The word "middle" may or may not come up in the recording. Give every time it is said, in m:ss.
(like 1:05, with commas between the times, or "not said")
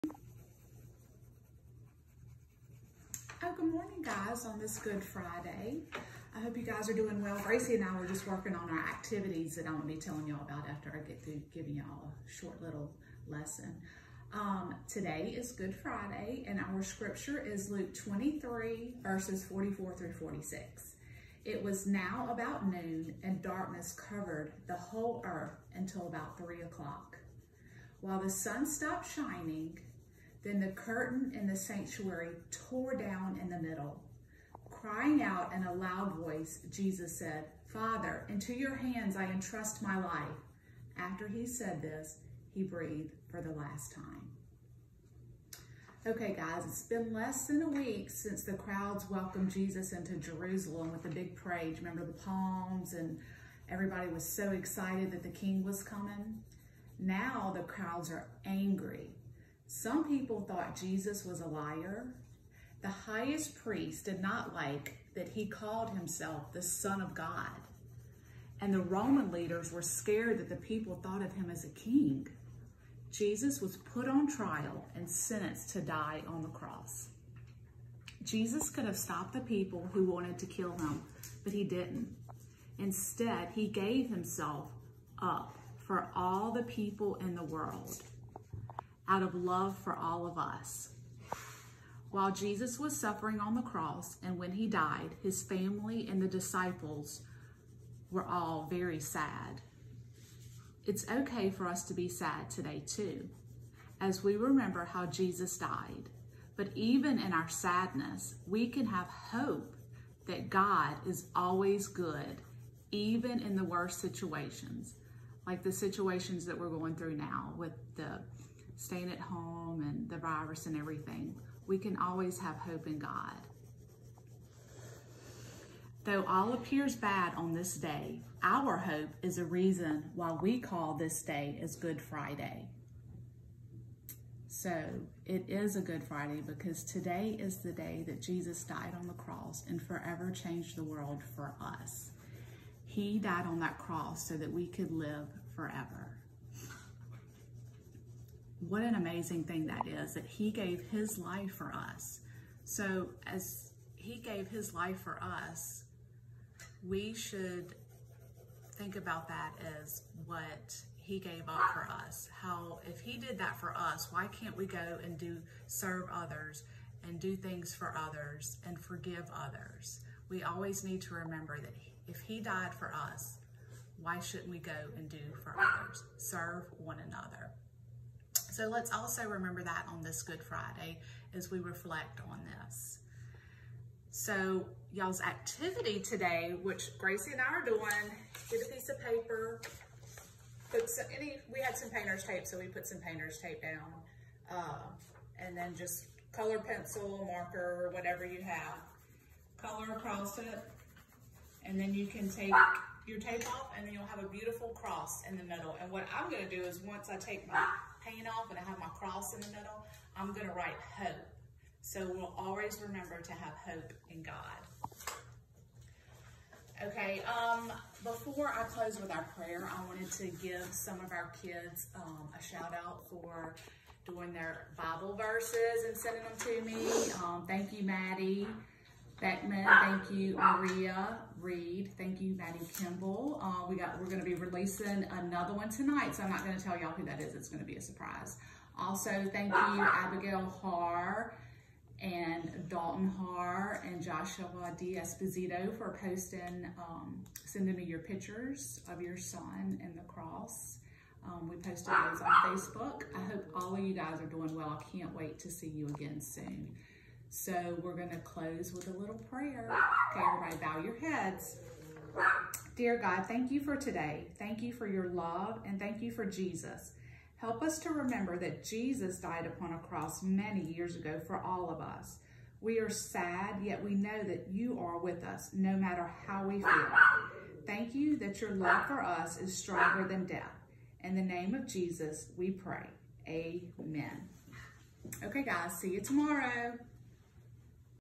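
0:33, 3:25, 3:29.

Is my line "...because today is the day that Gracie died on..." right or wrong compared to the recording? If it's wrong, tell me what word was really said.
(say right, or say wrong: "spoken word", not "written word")
wrong: "Jesus", not "Gracie".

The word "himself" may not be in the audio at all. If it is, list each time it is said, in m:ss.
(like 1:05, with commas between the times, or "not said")
1:05, 1:24.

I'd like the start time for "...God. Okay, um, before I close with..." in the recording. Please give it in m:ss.
3:34.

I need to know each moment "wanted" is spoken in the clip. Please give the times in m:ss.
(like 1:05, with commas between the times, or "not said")
1:20, 3:39.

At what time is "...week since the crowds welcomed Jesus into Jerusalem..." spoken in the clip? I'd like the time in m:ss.
0:47.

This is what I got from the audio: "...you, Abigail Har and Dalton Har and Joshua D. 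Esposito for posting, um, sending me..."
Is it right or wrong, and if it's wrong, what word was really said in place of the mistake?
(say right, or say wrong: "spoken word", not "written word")
right.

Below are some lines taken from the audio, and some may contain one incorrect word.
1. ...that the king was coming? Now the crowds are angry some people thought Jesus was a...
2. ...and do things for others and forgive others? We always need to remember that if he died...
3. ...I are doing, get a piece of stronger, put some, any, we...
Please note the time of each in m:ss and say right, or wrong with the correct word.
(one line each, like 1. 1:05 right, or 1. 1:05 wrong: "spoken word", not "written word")
1. 0:55 right
2. 2:47 right
3. 3:07 wrong: "paper", not "stronger".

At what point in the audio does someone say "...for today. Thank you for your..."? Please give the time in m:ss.
4:23.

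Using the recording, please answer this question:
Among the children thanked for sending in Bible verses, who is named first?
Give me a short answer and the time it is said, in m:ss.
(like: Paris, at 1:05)
Maddie Beckman, at 3:47.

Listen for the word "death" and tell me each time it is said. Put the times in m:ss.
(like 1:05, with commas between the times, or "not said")
4:40.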